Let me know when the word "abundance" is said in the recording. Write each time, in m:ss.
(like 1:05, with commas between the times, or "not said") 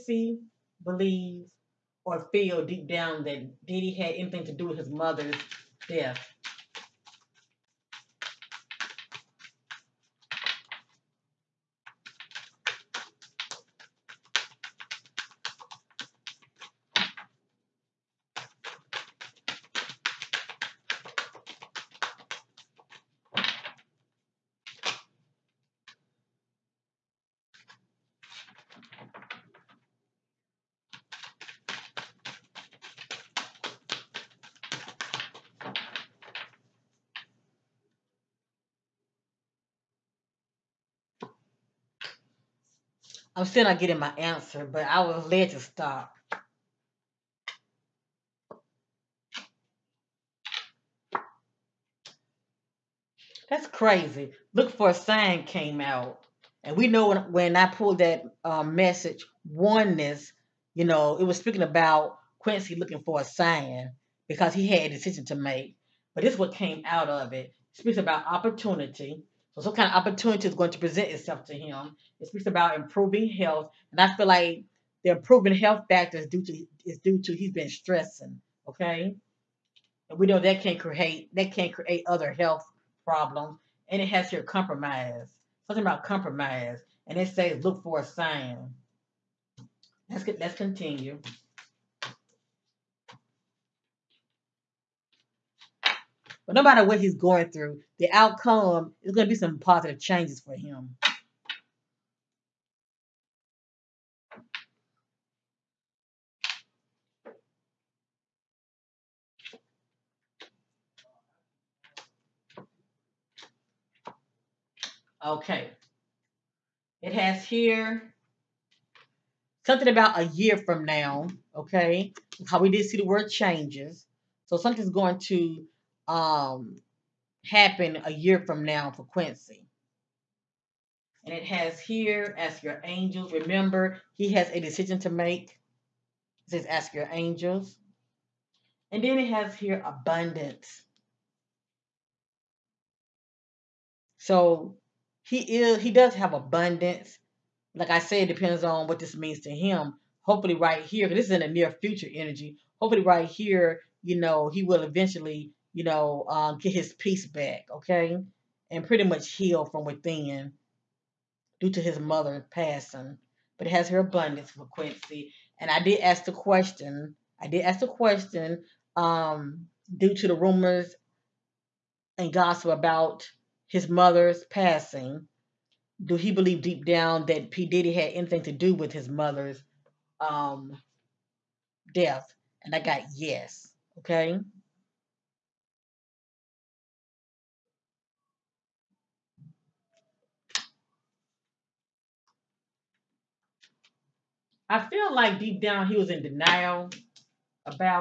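2:19, 2:26, 2:43.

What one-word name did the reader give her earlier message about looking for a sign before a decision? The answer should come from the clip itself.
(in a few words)
Oneness.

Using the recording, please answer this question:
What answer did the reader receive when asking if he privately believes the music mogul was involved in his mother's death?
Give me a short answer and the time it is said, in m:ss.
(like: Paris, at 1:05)
Yes, at 3:03.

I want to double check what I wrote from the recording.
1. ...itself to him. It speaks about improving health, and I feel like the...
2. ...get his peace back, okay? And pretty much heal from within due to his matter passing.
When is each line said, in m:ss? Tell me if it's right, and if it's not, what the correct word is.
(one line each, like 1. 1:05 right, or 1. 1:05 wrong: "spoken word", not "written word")
1. 1:11 right
2. 2:36 wrong: "mother", not "matter".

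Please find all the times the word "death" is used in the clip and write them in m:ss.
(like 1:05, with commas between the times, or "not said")
0:05, 3:01.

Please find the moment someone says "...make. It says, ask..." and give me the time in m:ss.
2:15.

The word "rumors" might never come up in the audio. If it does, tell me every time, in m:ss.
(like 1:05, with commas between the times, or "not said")
2:50.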